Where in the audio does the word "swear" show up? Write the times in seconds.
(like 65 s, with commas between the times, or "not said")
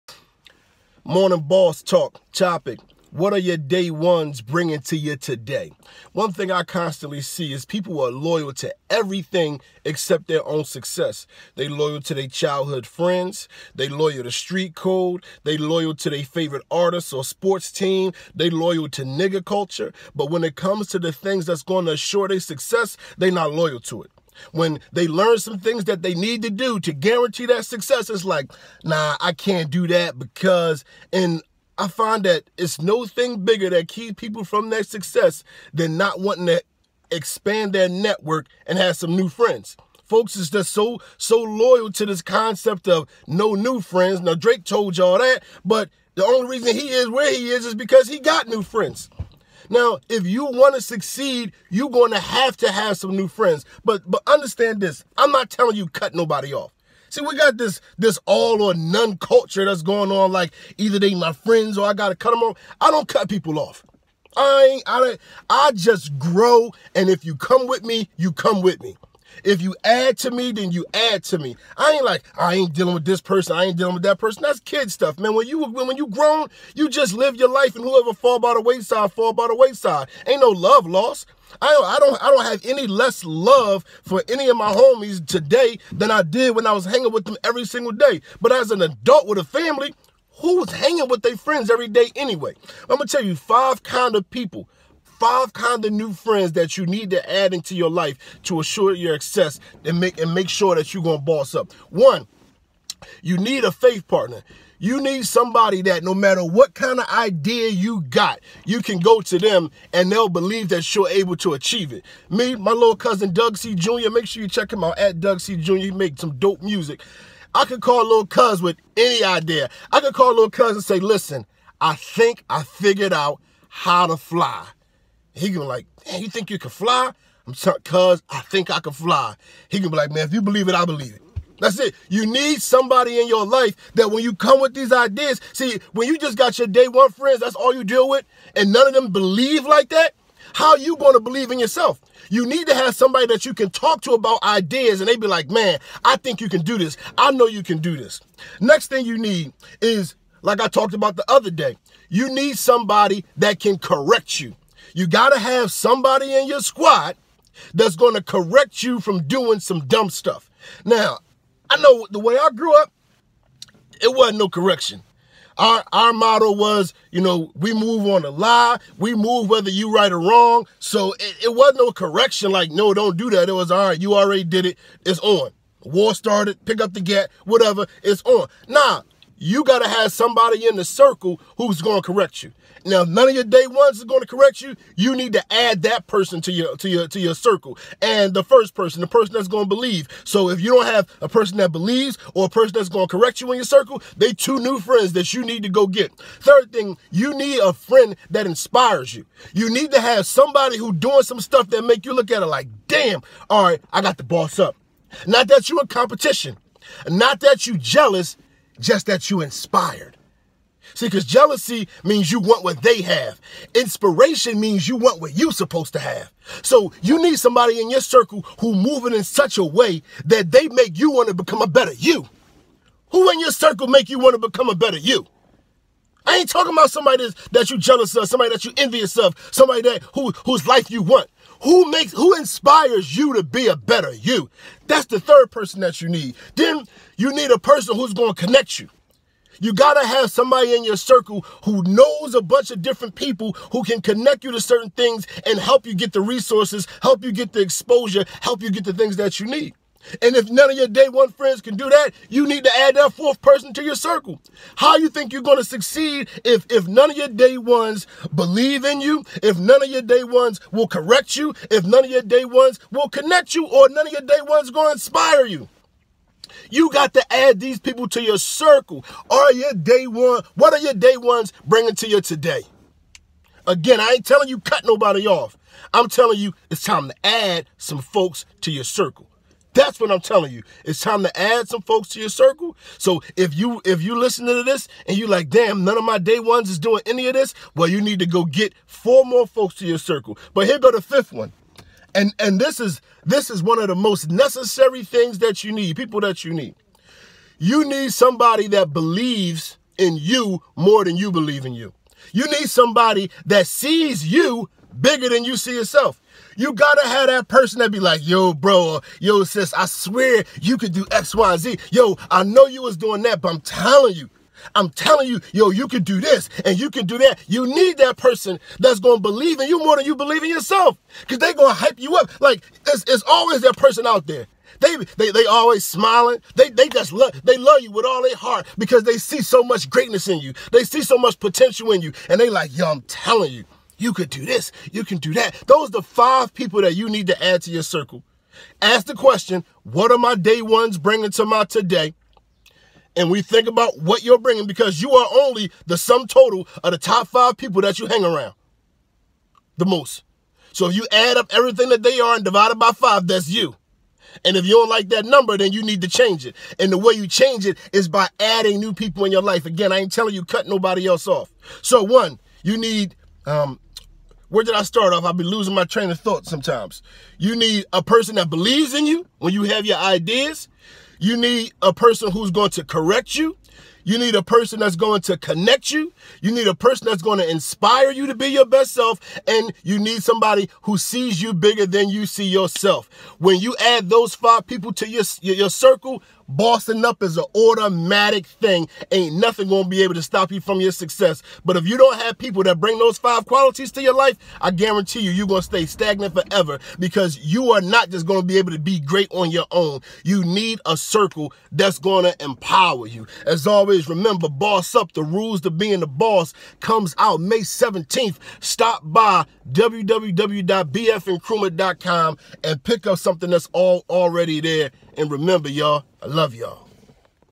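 309 s.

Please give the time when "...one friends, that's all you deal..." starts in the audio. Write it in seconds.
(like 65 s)
136 s.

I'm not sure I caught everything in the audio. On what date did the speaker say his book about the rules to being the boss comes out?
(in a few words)
May 17.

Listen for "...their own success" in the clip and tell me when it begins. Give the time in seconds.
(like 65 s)
10 s.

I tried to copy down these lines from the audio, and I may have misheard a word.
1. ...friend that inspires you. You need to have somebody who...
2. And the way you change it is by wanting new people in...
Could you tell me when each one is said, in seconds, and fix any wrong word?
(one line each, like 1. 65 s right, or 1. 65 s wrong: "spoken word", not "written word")
1. 197 s right
2. 356 s wrong: "adding", not "wanting".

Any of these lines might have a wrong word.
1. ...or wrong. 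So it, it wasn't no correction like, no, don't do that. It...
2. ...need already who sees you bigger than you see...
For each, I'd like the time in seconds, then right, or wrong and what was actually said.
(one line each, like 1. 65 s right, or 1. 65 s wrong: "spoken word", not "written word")
1. 170 s right
2. 379 s wrong: "somebody", not "already".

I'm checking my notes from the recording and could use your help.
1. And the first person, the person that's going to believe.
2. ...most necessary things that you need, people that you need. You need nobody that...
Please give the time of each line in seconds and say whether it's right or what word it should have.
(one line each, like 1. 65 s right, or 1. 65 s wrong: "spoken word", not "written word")
1. 188 s right
2. 293 s wrong: "somebody", not "nobody".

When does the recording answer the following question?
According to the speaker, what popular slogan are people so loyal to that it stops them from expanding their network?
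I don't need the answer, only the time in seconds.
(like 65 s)
43 s.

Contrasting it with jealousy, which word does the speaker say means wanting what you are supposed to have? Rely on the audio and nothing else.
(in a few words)
Inspiration.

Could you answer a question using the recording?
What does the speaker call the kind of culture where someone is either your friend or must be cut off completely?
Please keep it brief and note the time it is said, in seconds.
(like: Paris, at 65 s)
All or none culture, at 58 s.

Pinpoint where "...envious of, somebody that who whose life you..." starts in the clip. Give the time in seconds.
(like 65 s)
228 s.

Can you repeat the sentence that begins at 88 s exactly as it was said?
But as an adult with a family, who's hanging with their friends every day anyway?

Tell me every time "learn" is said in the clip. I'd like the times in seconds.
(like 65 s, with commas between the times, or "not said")
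25 s.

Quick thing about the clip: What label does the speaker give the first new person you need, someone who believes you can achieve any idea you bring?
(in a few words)
Faith partner.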